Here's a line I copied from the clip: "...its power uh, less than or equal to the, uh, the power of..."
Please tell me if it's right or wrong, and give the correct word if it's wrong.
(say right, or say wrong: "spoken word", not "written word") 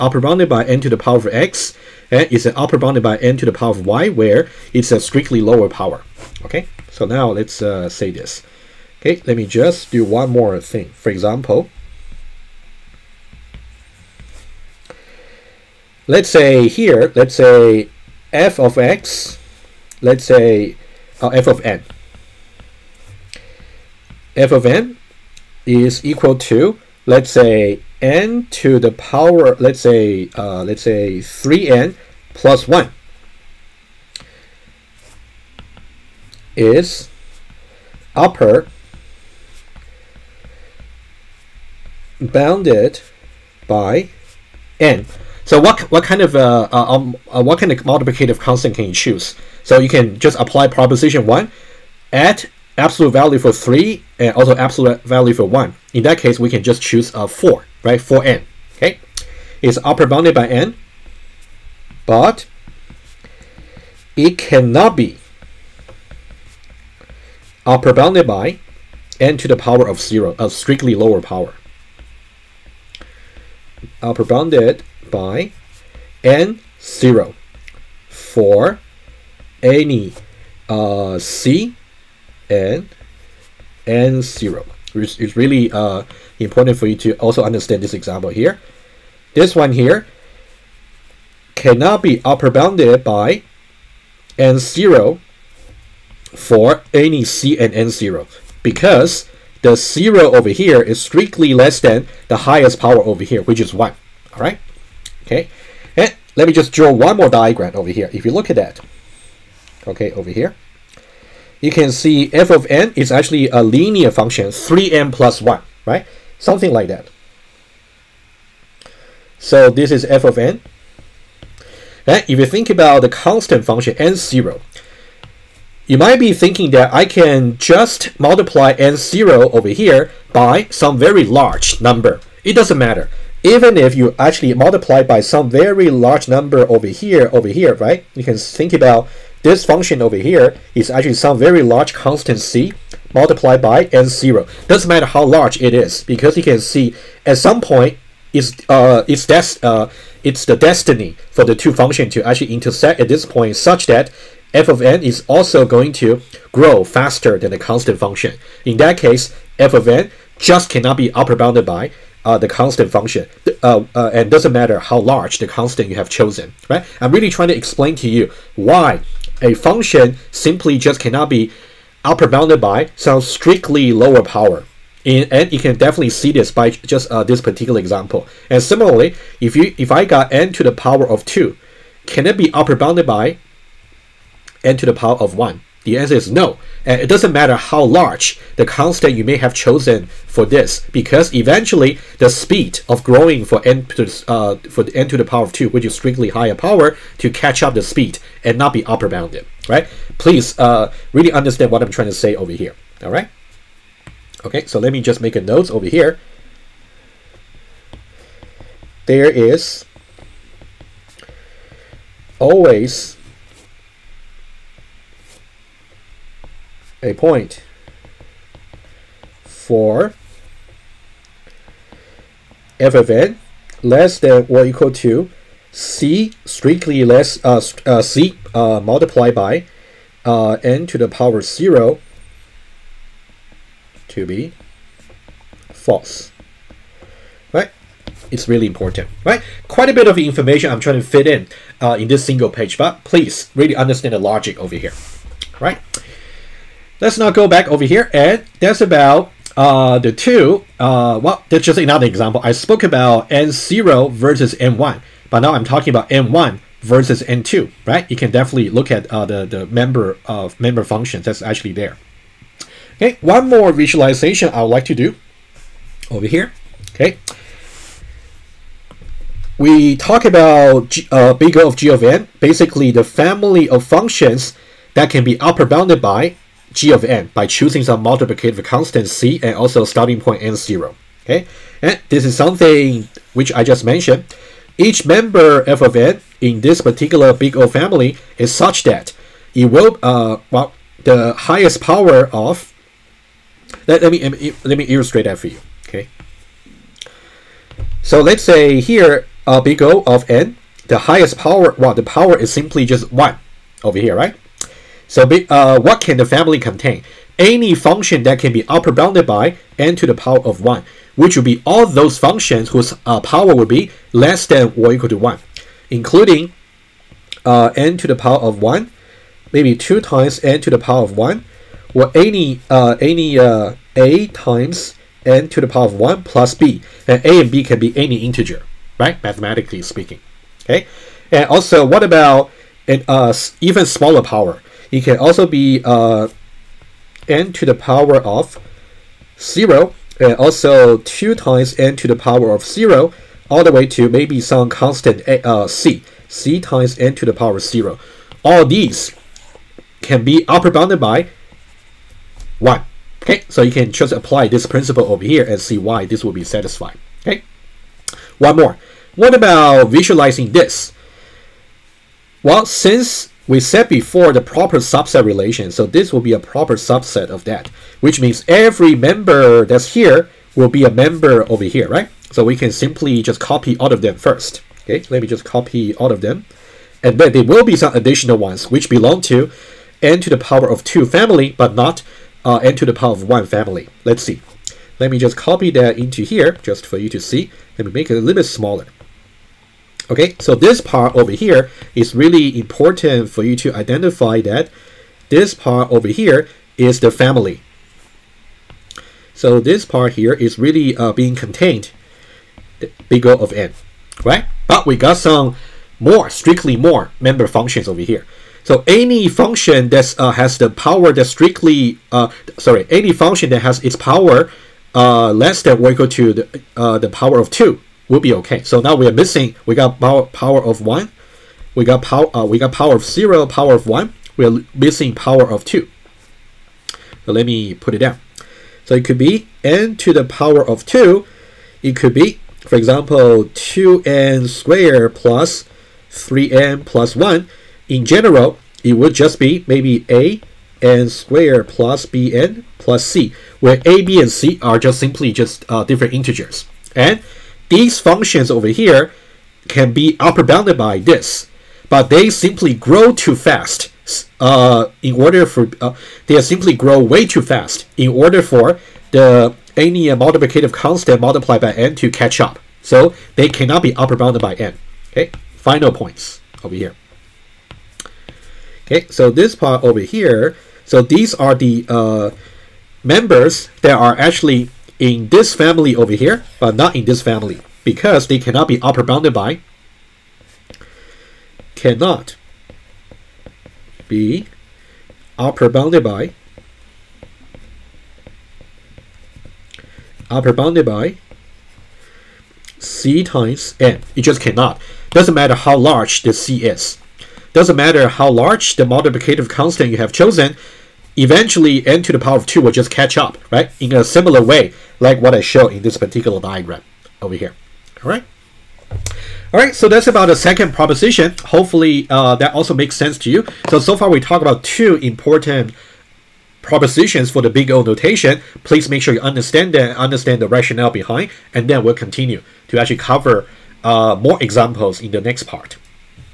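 right.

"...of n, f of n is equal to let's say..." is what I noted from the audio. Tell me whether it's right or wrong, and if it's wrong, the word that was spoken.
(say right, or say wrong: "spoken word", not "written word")
right.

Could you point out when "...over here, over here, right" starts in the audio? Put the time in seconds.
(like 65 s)
136 s.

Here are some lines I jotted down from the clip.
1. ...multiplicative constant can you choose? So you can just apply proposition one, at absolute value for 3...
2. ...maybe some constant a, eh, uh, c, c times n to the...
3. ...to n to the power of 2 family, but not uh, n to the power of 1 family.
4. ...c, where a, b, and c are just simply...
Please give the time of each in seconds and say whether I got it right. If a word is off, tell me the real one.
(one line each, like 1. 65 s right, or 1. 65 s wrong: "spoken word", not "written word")
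1. 47 s right
2. 344 s right
3. 379 s right
4. 443 s right.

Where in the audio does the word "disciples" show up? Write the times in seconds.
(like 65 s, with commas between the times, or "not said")
not said.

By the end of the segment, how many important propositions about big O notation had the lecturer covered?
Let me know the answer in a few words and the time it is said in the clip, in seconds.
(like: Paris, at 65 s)
2, at 514 s.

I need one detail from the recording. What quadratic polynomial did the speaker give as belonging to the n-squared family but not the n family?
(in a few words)
2n^2 + 3n + 1.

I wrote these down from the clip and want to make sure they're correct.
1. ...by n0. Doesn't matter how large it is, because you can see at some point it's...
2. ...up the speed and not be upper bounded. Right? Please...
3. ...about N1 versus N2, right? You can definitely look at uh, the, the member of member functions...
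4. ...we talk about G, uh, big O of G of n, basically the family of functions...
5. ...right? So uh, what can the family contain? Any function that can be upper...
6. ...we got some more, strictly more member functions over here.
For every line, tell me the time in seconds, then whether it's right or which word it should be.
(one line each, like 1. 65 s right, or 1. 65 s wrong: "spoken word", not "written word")
1. 143 s right
2. 197 s right
3. 255 s right
4. 269 s right
5. 304 s right
6. 404 s right.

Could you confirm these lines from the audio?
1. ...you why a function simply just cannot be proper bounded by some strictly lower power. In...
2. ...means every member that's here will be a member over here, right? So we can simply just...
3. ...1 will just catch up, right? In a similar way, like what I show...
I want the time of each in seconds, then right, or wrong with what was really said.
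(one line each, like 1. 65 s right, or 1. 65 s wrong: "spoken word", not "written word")
1. 168 s wrong: "upper", not "proper"
2. 368 s right
3. 502 s wrong: "2", not "1".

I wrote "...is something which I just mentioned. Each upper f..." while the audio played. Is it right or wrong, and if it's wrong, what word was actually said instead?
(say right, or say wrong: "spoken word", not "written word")
wrong: "member", not "upper".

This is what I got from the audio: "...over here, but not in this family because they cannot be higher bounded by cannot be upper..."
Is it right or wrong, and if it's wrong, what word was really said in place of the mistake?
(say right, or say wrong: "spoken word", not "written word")
wrong: "upper", not "higher".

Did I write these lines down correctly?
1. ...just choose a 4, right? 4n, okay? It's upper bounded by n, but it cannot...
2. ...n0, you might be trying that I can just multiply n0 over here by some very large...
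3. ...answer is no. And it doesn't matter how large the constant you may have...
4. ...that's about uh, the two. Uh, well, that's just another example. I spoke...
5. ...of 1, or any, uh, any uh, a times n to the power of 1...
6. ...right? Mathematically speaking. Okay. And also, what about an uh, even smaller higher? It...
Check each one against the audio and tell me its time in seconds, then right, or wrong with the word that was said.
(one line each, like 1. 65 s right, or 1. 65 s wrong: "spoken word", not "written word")
1. 56 s right
2. 123 s wrong: "thinking", not "trying"
3. 185 s right
4. 248 s right
5. 321 s right
6. 328 s wrong: "power", not "higher".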